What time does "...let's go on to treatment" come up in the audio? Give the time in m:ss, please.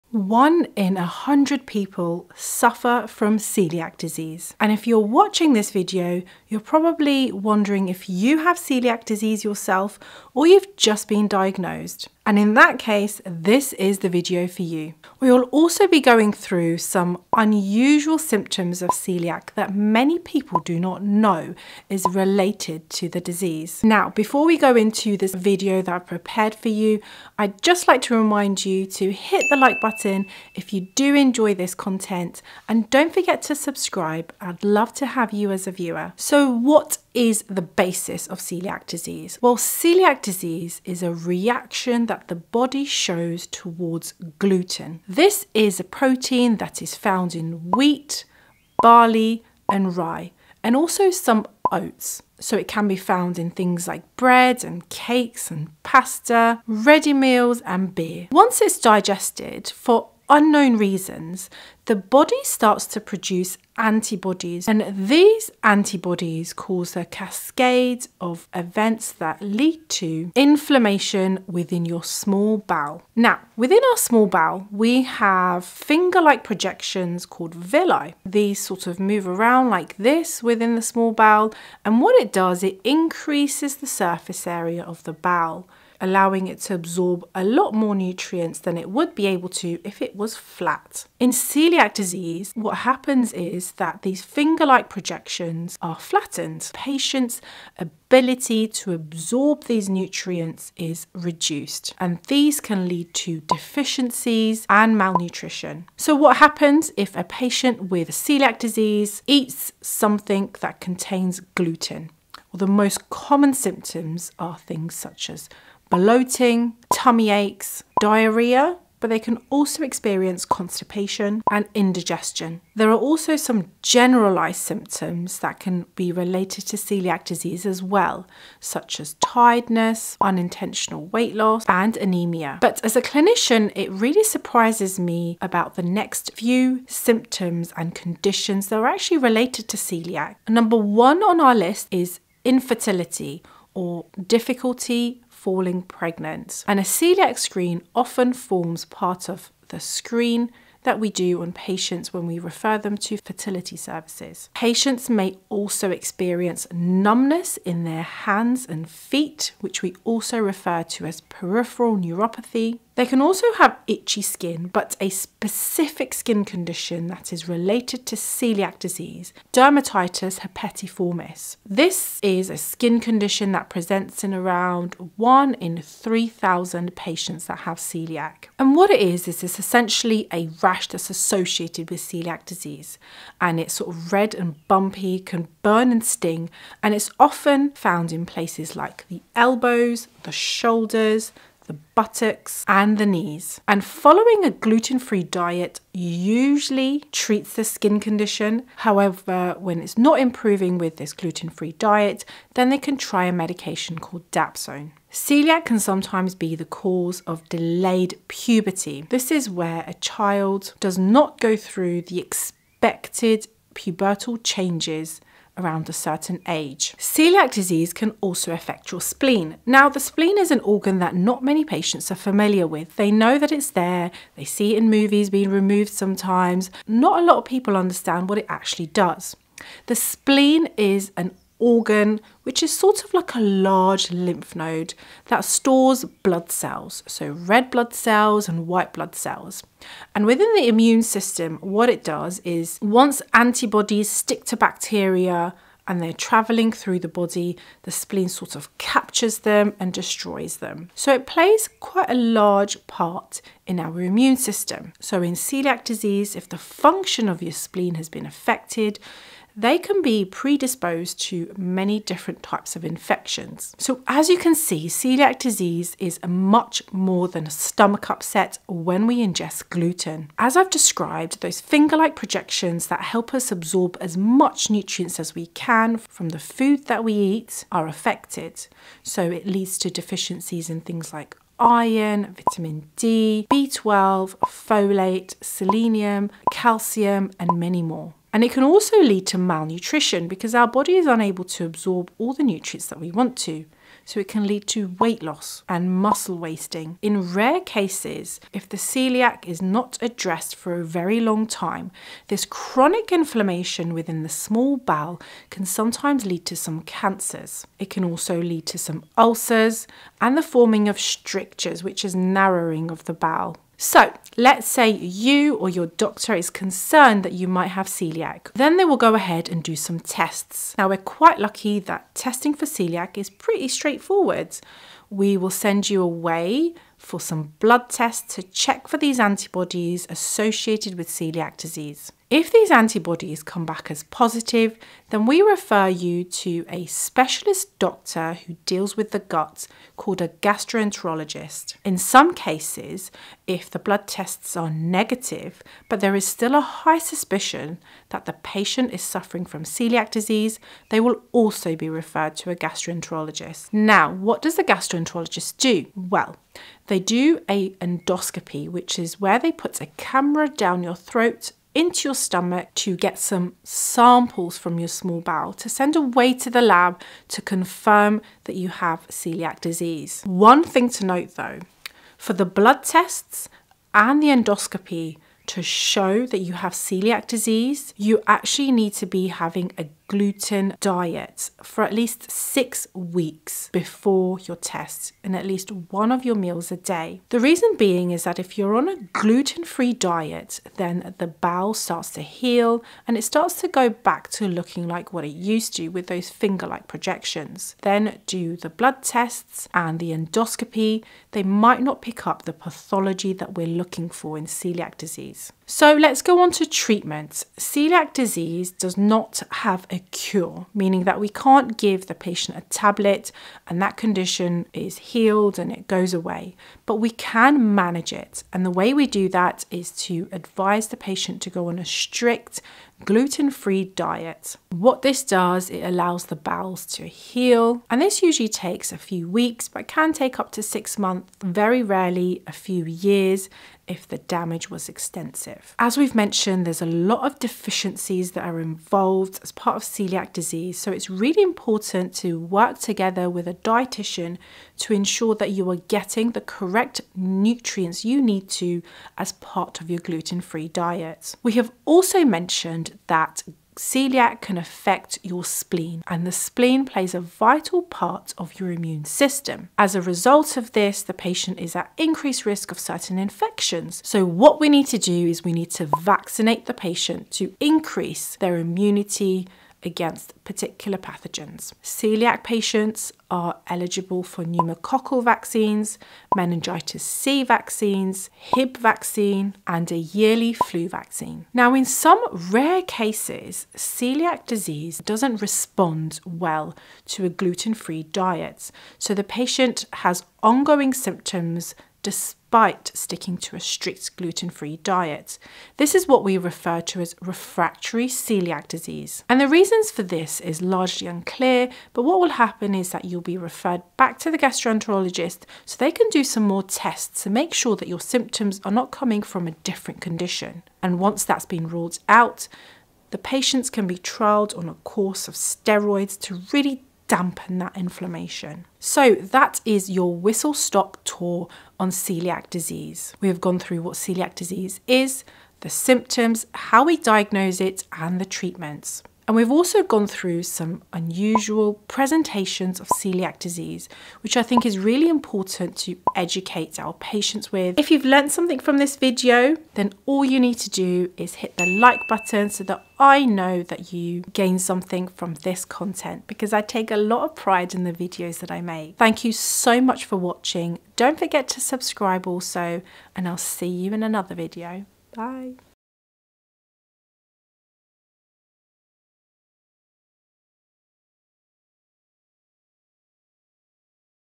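6:45.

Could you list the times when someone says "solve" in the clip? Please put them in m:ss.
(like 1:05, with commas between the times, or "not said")
not said.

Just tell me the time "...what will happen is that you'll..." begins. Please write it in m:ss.
8:22.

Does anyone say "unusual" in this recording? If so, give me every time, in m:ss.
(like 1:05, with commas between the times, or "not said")
0:17, 8:50.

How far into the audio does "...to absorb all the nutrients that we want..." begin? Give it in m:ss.
4:51.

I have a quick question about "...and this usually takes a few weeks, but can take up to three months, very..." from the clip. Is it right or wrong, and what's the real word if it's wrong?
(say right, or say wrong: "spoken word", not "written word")
wrong: "six", not "three".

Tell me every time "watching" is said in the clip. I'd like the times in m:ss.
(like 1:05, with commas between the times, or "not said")
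0:04, 9:10.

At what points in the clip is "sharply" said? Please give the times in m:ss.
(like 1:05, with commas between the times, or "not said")
not said.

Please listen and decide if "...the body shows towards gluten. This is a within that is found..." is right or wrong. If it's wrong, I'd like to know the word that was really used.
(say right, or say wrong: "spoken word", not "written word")
wrong: "protein", not "within".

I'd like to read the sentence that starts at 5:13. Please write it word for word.
So let's say you or your doctor is concerned that you might have celiac.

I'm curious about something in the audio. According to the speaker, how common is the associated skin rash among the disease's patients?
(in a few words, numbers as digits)
1 in 3,000.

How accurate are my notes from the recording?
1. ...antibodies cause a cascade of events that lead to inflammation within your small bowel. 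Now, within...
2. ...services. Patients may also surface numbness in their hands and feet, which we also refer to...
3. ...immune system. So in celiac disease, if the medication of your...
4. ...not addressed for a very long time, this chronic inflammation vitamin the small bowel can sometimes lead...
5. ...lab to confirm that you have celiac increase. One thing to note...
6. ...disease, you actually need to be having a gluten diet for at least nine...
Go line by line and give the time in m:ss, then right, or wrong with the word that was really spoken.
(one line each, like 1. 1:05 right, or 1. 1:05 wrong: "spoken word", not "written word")
1. 1:05 right
2. 2:33 wrong: "experience", not "surface"
3. 4:13 wrong: "function", not "medication"
4. 4:59 wrong: "within", not "vitamin"
5. 6:06 wrong: "disease", not "increase"
6. 6:17 wrong: "six", not "nine".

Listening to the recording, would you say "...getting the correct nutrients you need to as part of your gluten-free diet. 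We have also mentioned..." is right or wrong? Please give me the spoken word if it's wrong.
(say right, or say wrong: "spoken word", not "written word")
right.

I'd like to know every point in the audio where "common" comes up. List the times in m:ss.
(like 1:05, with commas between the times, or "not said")
1:53.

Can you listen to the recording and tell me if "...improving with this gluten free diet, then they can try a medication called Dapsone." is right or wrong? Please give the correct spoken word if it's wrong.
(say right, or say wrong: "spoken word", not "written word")
right.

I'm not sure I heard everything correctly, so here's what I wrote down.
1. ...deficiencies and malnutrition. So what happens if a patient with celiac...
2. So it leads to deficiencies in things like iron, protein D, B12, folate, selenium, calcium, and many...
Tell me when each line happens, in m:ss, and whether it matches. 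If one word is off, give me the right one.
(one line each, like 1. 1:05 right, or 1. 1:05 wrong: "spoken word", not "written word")
1. 1:43 right
2. 4:39 wrong: "vitamin", not "protein".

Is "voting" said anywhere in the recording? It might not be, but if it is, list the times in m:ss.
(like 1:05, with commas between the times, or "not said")
not said.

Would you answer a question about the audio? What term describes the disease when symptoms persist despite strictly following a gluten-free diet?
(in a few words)
refractory celiac disease.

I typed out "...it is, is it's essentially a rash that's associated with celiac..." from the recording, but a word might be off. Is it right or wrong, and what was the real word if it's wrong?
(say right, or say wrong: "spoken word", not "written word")
right.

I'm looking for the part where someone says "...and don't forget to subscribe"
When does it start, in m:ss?
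0:32.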